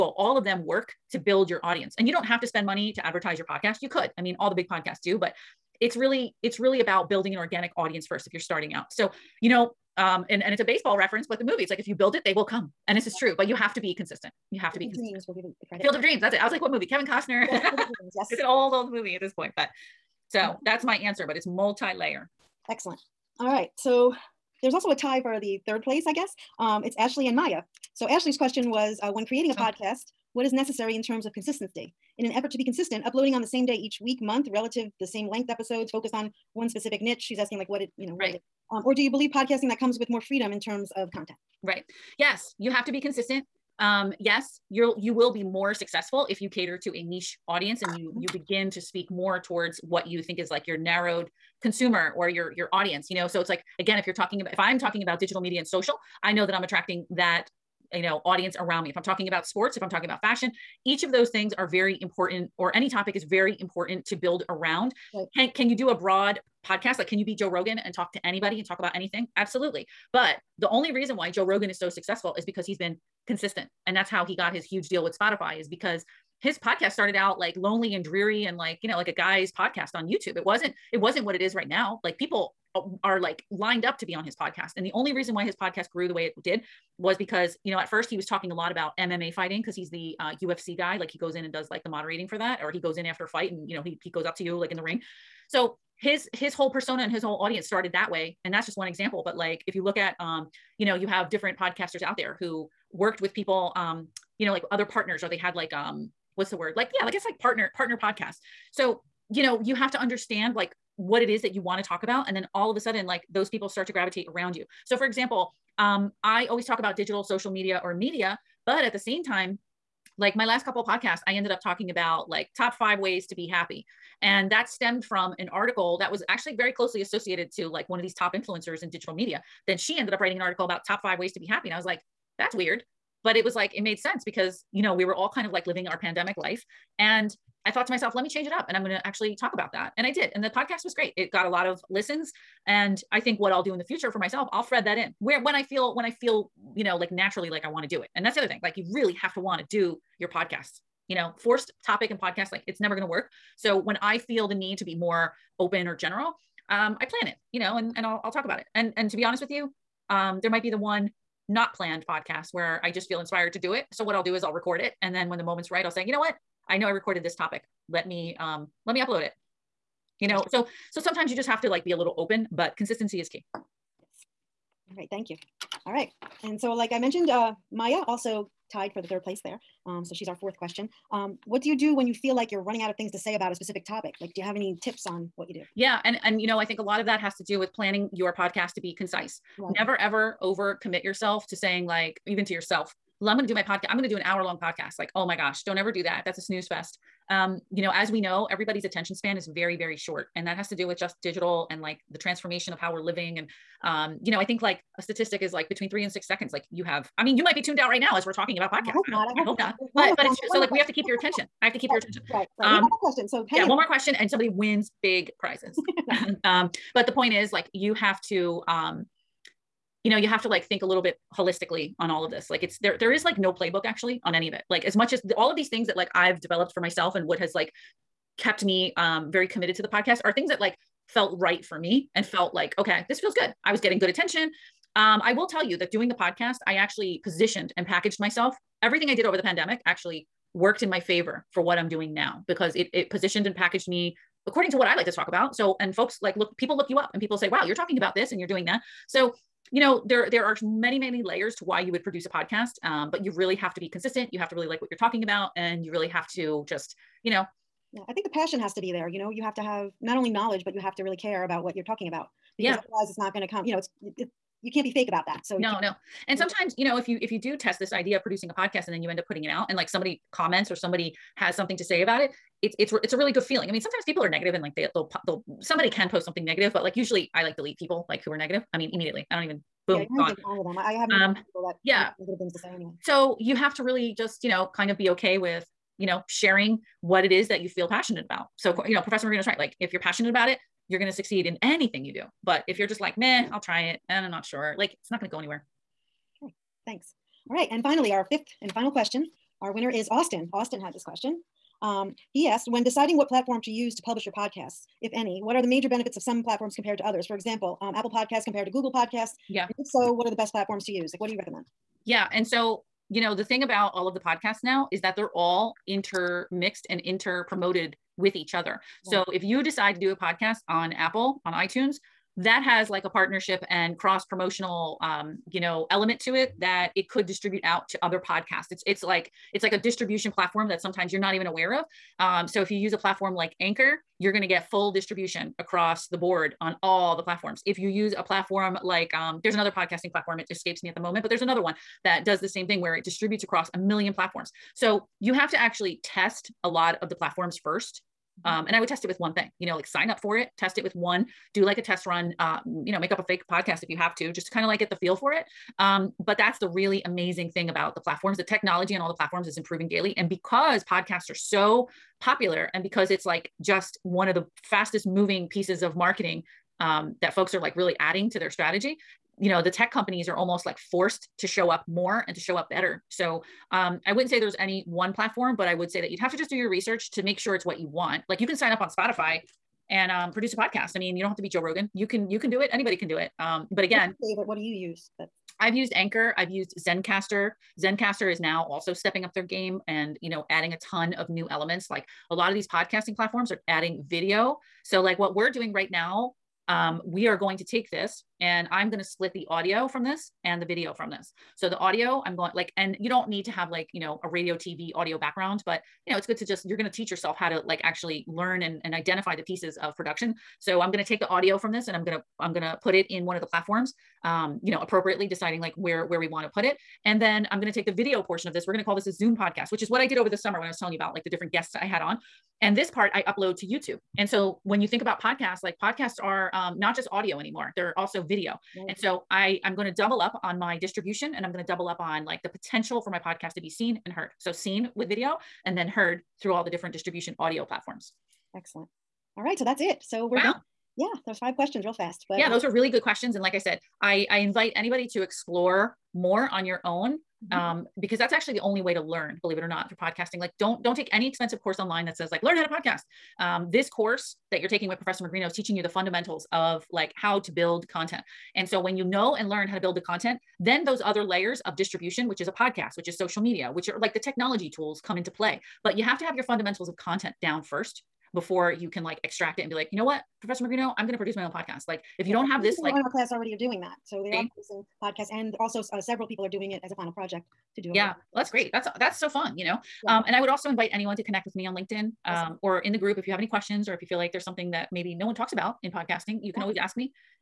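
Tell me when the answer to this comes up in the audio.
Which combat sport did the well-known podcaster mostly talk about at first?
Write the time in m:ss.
1:28.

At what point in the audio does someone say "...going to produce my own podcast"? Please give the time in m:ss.
7:51.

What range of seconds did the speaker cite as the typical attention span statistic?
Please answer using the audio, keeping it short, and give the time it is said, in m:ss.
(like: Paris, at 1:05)
3 to 6 seconds, at 3:25.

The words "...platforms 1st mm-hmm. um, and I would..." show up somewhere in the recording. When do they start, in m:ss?
5:47.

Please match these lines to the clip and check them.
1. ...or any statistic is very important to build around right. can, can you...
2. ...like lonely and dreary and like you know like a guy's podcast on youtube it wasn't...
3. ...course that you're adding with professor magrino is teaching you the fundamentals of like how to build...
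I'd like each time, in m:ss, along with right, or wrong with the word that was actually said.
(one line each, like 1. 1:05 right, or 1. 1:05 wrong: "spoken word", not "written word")
1. 1:02 wrong: "topic", not "statistic"
2. 1:17 right
3. 7:33 wrong: "taking", not "adding".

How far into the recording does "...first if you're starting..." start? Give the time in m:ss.
0:08.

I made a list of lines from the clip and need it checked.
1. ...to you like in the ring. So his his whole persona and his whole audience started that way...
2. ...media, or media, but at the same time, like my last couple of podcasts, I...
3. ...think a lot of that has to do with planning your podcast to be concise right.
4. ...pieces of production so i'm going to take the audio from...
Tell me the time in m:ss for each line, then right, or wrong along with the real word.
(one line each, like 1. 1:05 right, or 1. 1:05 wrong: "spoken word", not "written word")
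1. 1:34 right
2. 1:57 right
3. 3:06 right
4. 6:49 right.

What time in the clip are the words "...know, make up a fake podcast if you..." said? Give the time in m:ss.
5:52.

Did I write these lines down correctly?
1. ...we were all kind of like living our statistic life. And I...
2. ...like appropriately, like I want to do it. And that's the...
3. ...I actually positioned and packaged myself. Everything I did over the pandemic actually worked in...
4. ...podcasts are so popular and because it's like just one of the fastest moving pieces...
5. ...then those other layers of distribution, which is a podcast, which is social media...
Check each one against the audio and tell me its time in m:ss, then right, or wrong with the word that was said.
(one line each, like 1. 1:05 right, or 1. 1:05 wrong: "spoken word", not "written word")
1. 2:14 wrong: "pandemic", not "statistic"
2. 2:26 wrong: "naturally", not "appropriately"
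3. 3:56 right
4. 6:00 right
5. 7:40 right.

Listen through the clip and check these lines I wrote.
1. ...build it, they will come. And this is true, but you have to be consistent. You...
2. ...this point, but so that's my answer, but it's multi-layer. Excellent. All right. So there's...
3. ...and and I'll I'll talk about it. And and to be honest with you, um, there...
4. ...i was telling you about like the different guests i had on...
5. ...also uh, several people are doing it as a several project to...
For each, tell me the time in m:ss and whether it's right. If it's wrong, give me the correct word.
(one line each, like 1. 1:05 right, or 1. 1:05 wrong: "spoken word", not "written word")
1. 0:11 right
2. 0:19 right
3. 2:37 right
4. 7:00 right
5. 7:55 wrong: "final", not "several".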